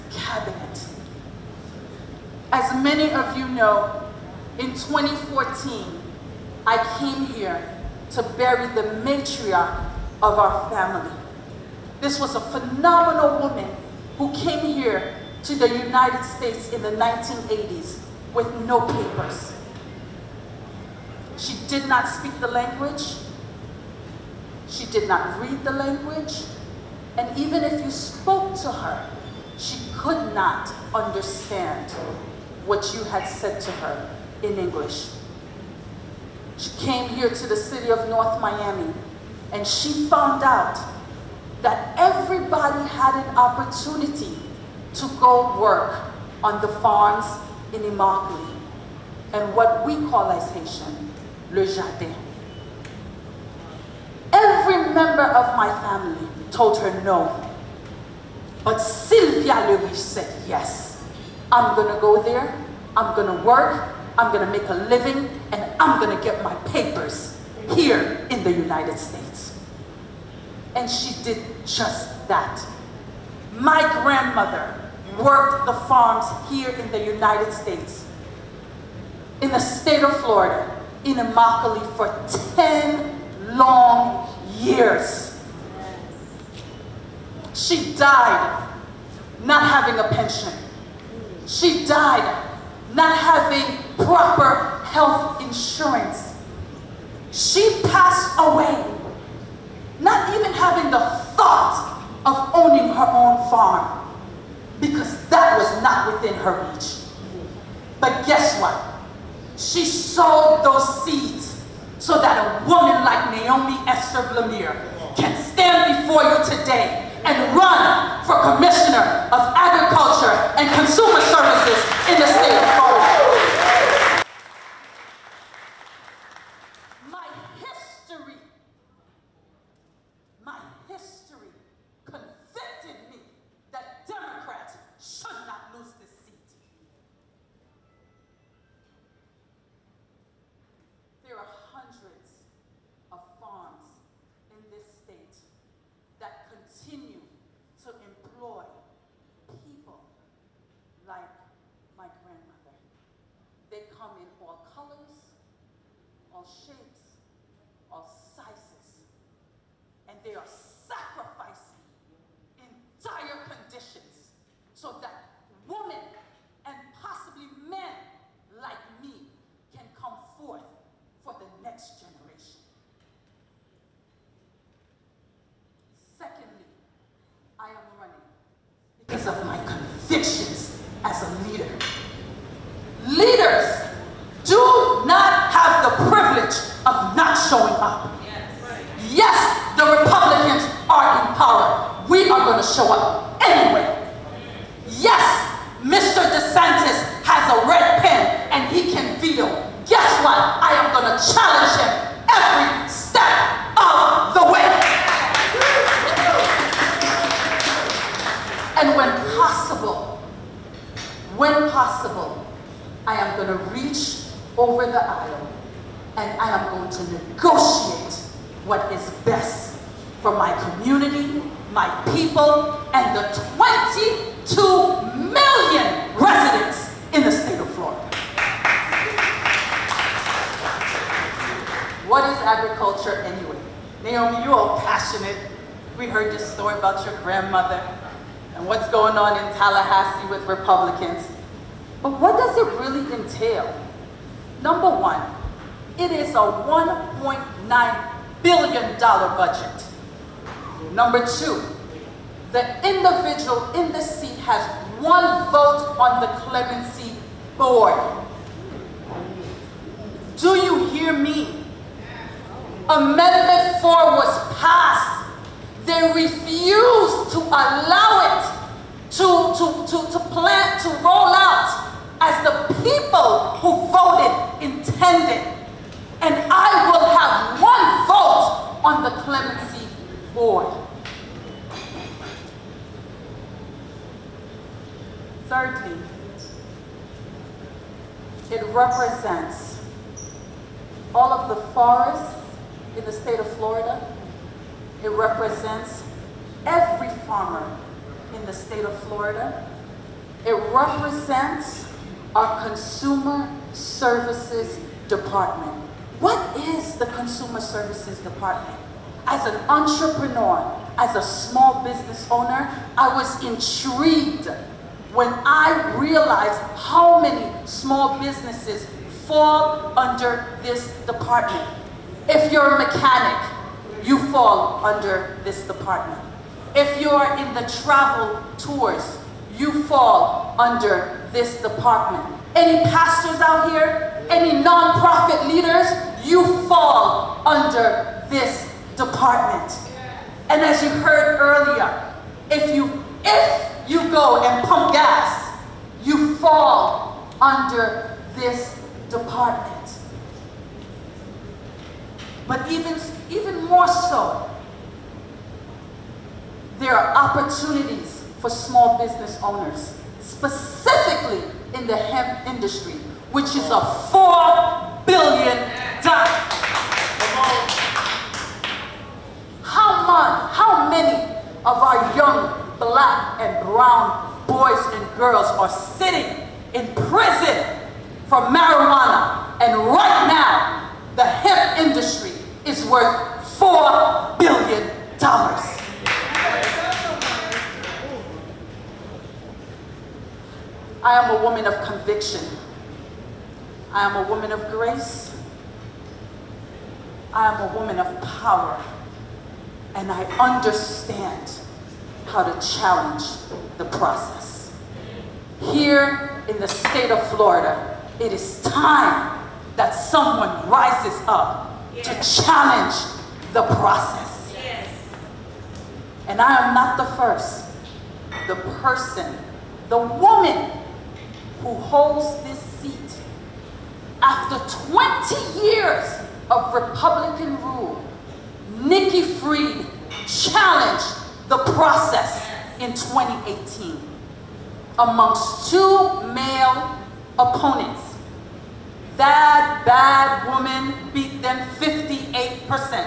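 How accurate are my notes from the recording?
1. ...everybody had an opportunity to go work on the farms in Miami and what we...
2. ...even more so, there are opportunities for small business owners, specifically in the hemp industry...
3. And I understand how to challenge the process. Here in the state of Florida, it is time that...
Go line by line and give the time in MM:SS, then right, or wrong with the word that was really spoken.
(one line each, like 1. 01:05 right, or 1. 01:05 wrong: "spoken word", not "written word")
1. 00:41 wrong: "Immokalee", not "Miami"
2. 05:53 right
3. 06:39 right.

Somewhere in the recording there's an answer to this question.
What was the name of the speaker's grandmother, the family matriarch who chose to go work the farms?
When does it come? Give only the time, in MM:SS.
00:58.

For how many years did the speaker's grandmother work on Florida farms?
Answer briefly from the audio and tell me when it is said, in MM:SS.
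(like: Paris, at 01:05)
10, at 01:22.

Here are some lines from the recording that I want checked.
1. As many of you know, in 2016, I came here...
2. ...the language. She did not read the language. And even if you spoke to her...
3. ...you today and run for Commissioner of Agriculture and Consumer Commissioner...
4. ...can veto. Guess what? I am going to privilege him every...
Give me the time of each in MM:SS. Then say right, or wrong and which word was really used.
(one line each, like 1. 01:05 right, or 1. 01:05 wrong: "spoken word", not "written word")
1. 00:02 wrong: "2014", not "2016"
2. 00:22 right
3. 01:56 wrong: "Services", not "Commissioner"
4. 03:18 wrong: "challenge", not "privilege".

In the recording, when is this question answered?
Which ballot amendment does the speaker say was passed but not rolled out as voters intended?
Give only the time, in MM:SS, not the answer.
04:22.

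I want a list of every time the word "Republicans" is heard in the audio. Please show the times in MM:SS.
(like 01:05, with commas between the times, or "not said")
03:09, 04:00, 07:06.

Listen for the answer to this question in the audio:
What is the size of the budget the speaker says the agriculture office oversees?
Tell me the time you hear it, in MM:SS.
04:06.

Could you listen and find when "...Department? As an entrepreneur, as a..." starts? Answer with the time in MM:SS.
05:08.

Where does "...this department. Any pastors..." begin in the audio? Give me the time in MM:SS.
05:31.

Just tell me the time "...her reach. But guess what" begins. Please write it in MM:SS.
01:46.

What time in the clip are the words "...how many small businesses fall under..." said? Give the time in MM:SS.
05:16.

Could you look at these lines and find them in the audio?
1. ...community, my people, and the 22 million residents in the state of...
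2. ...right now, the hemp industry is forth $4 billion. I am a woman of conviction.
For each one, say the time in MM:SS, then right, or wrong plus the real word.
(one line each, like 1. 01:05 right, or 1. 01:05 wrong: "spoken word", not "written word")
1. 03:40 right
2. 06:19 wrong: "worth", not "forth".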